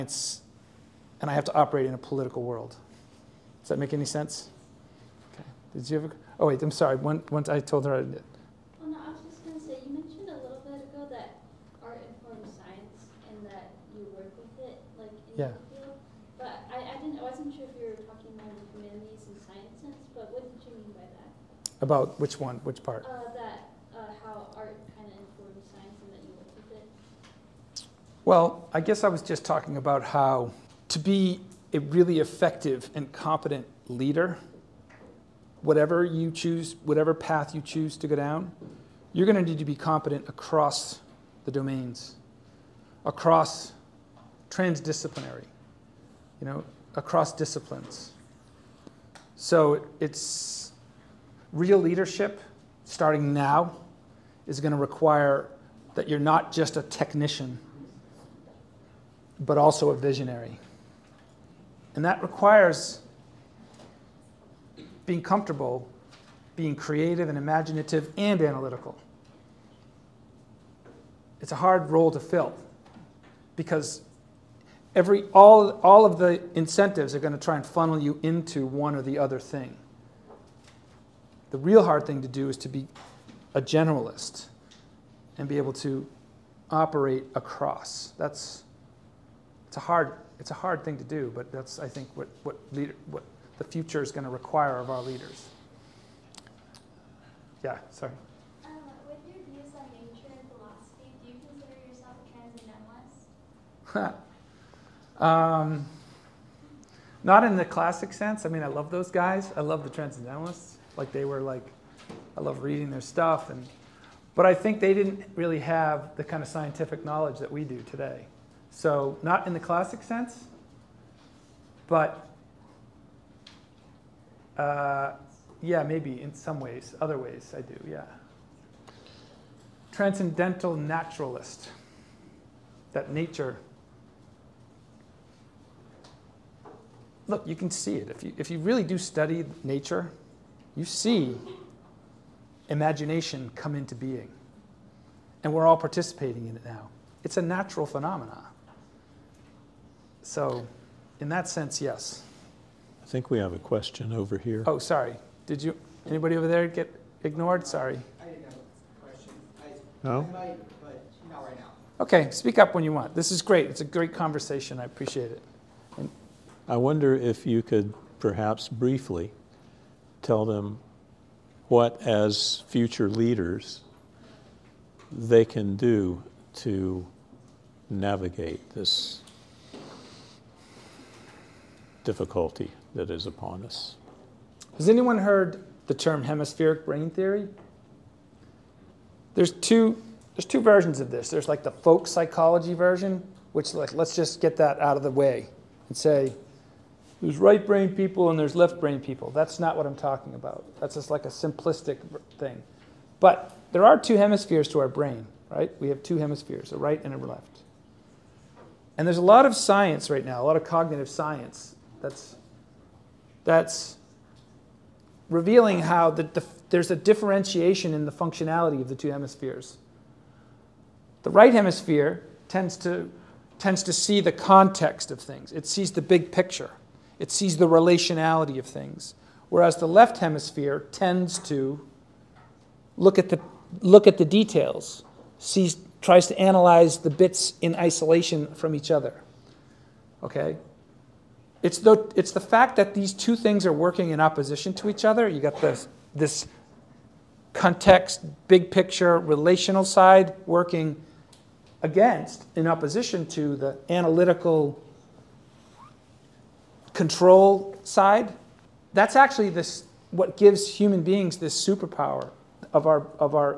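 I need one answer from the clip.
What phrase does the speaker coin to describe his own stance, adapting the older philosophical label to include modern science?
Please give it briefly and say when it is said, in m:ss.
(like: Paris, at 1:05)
Transcendental naturalist, at 2:09.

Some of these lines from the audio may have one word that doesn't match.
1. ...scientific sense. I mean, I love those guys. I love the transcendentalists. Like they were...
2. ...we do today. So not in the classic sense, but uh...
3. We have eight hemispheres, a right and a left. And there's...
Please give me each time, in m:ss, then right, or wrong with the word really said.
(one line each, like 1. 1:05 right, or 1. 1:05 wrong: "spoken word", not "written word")
1. 1:47 wrong: "classic", not "scientific"
2. 1:57 right
3. 3:25 wrong: "two", not "eight".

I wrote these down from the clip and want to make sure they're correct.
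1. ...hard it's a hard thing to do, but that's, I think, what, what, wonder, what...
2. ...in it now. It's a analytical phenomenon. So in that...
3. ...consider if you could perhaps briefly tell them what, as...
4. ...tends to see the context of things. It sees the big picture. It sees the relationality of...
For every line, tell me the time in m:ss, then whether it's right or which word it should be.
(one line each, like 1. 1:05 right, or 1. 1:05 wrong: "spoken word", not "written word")
1. 1:29 wrong: "leader", not "wonder"
2. 2:26 wrong: "natural", not "analytical"
3. 2:46 wrong: "wonder", not "consider"
4. 3:43 right.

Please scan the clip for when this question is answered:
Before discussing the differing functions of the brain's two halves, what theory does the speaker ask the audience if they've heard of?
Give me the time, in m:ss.
3:06.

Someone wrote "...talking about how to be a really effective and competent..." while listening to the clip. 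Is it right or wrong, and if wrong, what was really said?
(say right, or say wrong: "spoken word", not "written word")
right.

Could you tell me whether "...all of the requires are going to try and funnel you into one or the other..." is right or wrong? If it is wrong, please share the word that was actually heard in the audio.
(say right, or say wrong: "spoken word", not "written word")
wrong: "incentives", not "requires".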